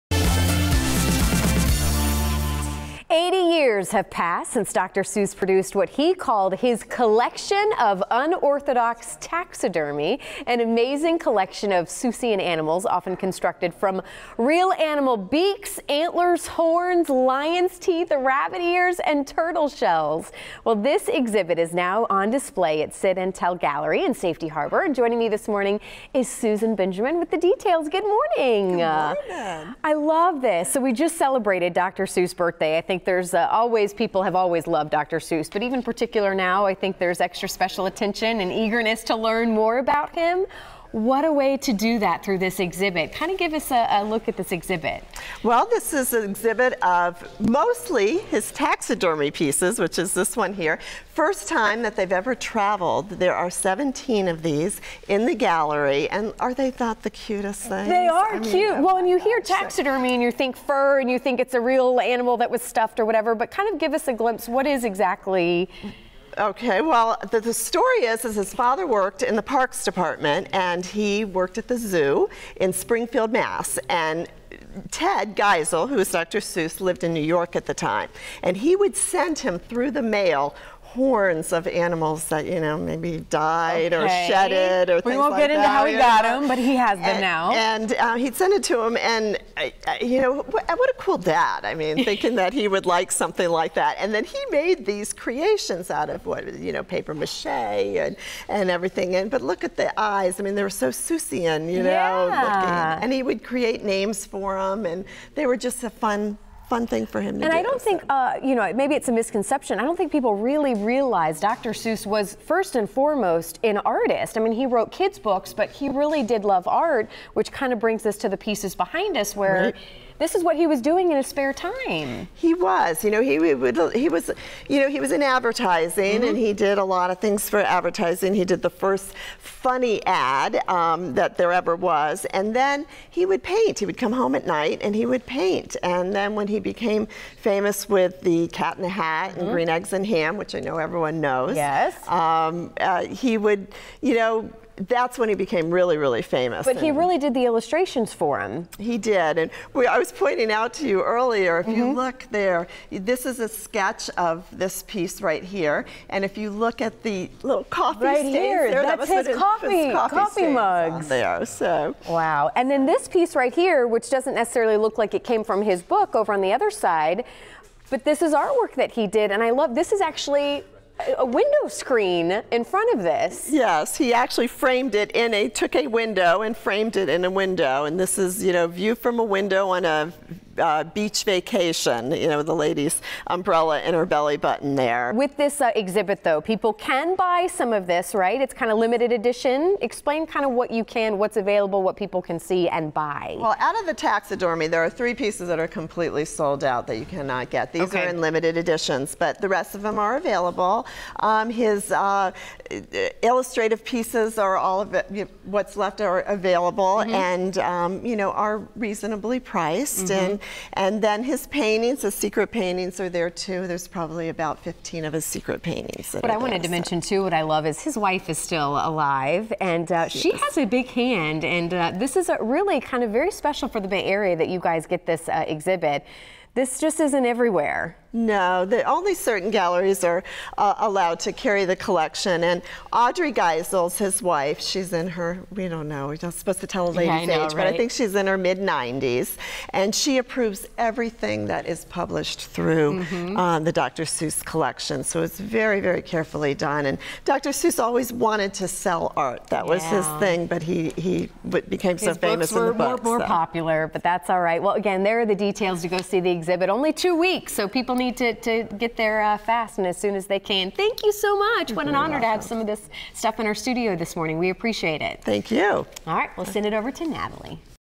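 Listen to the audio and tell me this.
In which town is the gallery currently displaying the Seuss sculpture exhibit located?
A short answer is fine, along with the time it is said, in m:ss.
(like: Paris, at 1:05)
Safety Harbor, at 0:24.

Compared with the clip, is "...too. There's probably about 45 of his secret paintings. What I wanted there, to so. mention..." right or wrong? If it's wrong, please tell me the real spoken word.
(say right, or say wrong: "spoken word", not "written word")
wrong: "15", not "45".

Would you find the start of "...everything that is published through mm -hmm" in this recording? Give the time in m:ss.
4:00.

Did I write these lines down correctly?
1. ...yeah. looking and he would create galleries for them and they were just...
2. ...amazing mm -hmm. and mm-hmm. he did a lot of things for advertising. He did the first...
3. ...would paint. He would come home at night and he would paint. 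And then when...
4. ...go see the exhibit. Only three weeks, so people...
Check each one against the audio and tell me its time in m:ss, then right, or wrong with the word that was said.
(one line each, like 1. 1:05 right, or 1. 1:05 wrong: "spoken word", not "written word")
1. 1:41 wrong: "names", not "galleries"
2. 2:05 wrong: "advertising", not "amazing"
3. 2:13 right
4. 4:15 wrong: "two", not "three".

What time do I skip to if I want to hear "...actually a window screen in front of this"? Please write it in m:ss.
2:50.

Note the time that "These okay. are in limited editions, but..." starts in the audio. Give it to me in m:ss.
3:17.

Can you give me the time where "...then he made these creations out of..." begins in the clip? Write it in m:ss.
1:34.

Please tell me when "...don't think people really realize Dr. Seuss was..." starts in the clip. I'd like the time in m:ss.
1:49.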